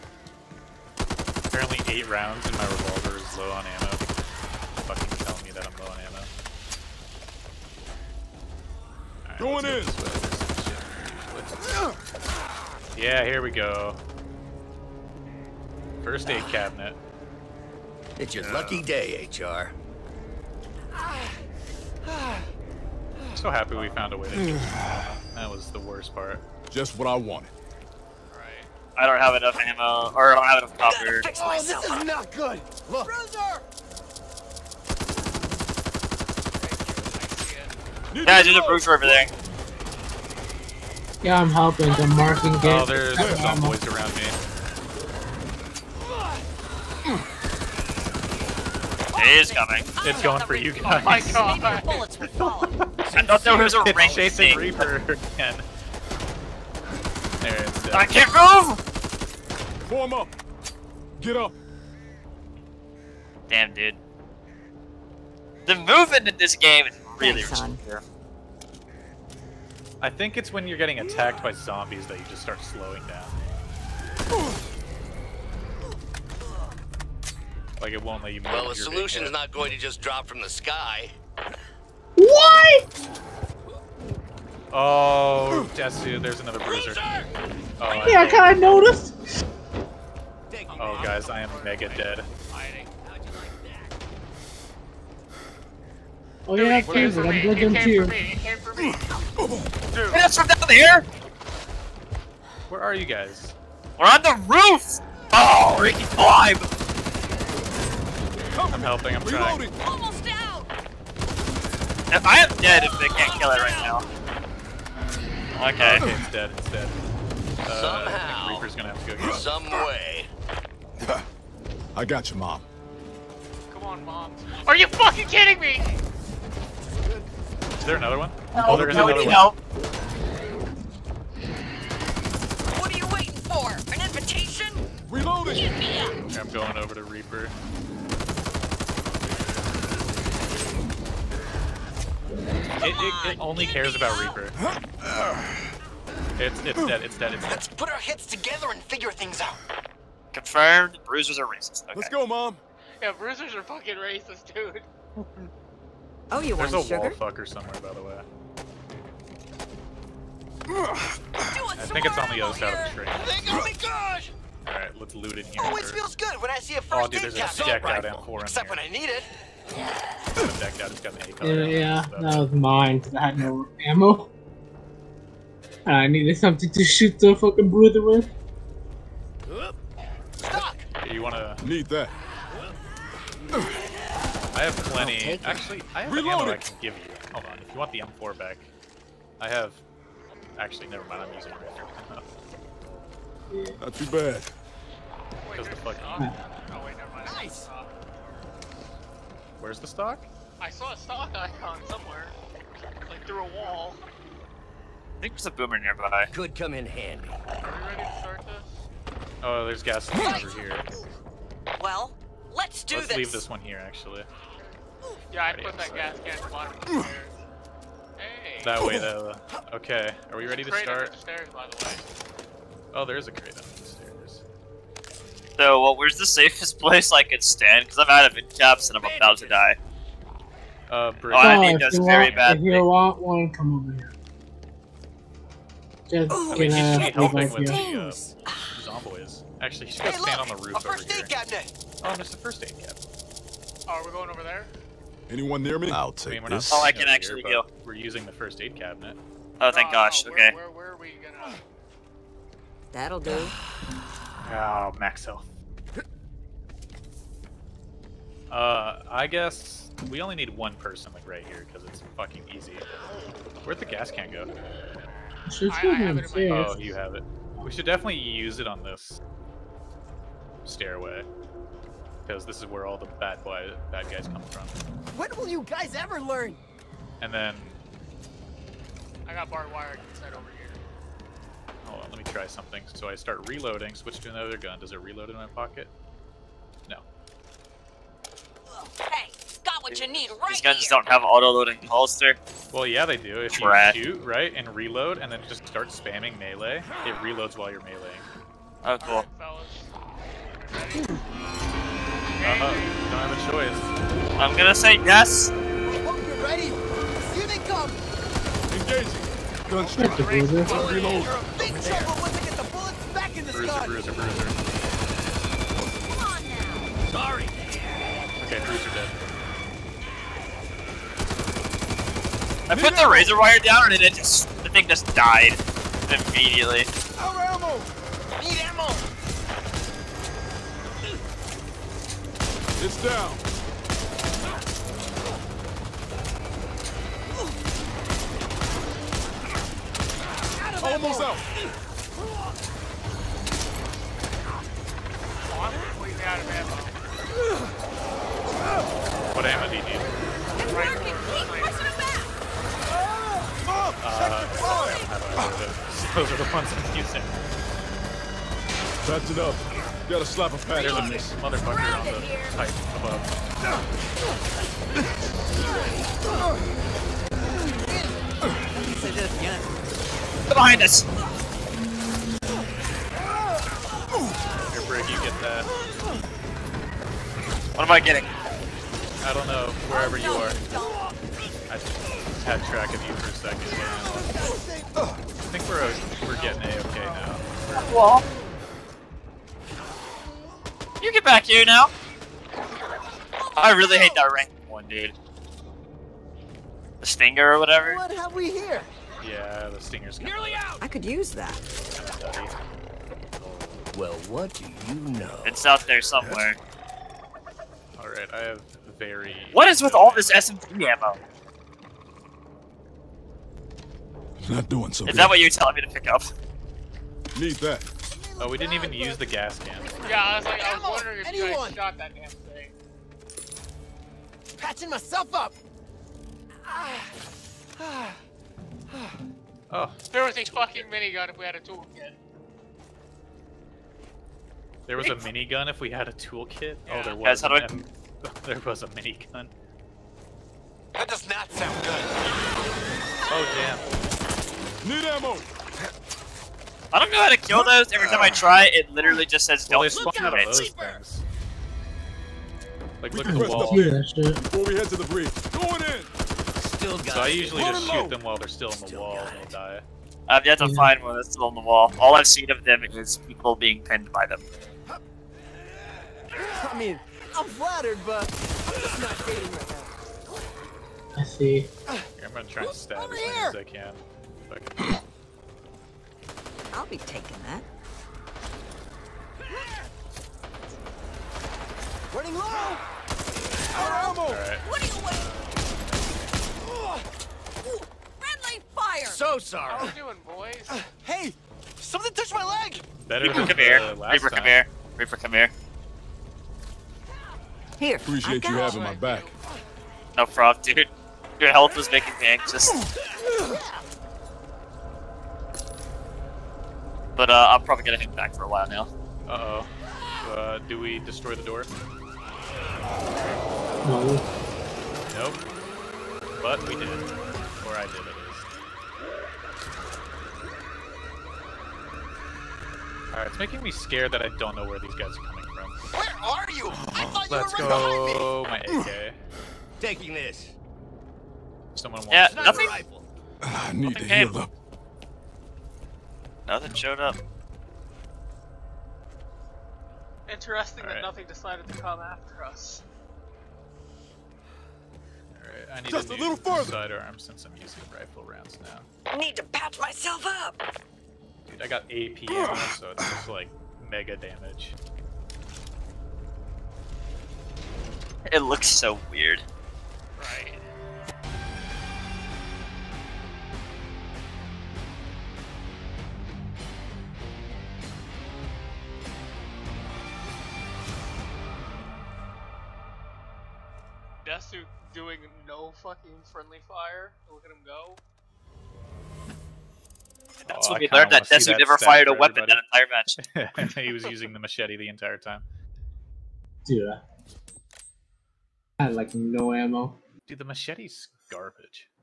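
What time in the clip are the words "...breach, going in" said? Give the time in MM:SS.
07:35.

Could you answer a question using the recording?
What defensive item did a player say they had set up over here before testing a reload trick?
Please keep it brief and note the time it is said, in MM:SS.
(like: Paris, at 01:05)
Barbed wire, at 04:39.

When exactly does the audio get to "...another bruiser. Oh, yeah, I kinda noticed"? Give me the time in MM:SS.
01:26.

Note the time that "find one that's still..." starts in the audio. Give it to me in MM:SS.
07:40.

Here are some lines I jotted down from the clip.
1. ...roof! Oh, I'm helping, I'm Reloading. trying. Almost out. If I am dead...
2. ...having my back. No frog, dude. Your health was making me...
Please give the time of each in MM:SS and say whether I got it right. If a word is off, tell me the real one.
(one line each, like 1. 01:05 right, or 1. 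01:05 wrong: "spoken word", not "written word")
1. 01:44 right
2. 08:18 right.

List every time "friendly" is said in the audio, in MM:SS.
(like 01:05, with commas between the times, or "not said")
08:08, 09:36.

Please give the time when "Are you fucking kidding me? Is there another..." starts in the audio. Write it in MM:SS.
02:04.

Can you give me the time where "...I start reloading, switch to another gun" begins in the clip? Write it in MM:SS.
04:43.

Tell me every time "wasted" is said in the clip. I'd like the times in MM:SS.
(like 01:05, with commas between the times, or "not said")
not said.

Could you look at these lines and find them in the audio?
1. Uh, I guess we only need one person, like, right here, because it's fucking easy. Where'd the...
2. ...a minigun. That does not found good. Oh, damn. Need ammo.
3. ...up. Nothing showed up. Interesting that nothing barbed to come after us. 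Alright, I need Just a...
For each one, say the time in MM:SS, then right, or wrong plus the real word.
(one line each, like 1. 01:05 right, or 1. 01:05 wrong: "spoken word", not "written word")
1. 04:18 right
2. 07:18 wrong: "sound", not "found"
3. 08:54 wrong: "decided", not "barbed".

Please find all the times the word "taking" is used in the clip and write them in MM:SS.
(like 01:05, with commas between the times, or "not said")
07:56, 08:49.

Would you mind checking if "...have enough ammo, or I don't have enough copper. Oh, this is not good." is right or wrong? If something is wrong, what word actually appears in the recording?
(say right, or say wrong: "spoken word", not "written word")
right.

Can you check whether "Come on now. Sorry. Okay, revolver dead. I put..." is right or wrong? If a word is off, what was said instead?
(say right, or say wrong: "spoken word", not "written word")
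wrong: "bruiser", not "revolver".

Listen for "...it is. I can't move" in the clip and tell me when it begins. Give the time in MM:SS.
00:57.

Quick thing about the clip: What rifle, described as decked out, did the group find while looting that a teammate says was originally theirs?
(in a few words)
M4.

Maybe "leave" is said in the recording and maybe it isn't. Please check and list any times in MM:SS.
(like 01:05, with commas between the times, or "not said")
03:33.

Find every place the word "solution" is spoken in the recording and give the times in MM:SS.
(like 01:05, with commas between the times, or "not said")
01:18.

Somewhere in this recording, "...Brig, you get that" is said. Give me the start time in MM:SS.
06:14.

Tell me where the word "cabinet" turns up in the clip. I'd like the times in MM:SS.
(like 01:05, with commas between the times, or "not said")
00:16, 04:02, 04:08.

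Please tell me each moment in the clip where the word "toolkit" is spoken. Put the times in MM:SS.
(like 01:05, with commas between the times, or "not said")
07:11, 07:16.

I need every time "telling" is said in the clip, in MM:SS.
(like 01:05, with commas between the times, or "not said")
00:05, 06:55.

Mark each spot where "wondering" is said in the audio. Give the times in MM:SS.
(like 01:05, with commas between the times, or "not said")
07:00.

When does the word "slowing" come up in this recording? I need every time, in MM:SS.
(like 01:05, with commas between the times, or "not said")
01:12.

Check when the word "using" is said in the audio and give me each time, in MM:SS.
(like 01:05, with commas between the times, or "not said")
03:11, 04:07, 05:56, 09:07, 09:44.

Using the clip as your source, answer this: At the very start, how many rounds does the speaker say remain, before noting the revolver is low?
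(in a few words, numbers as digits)
8.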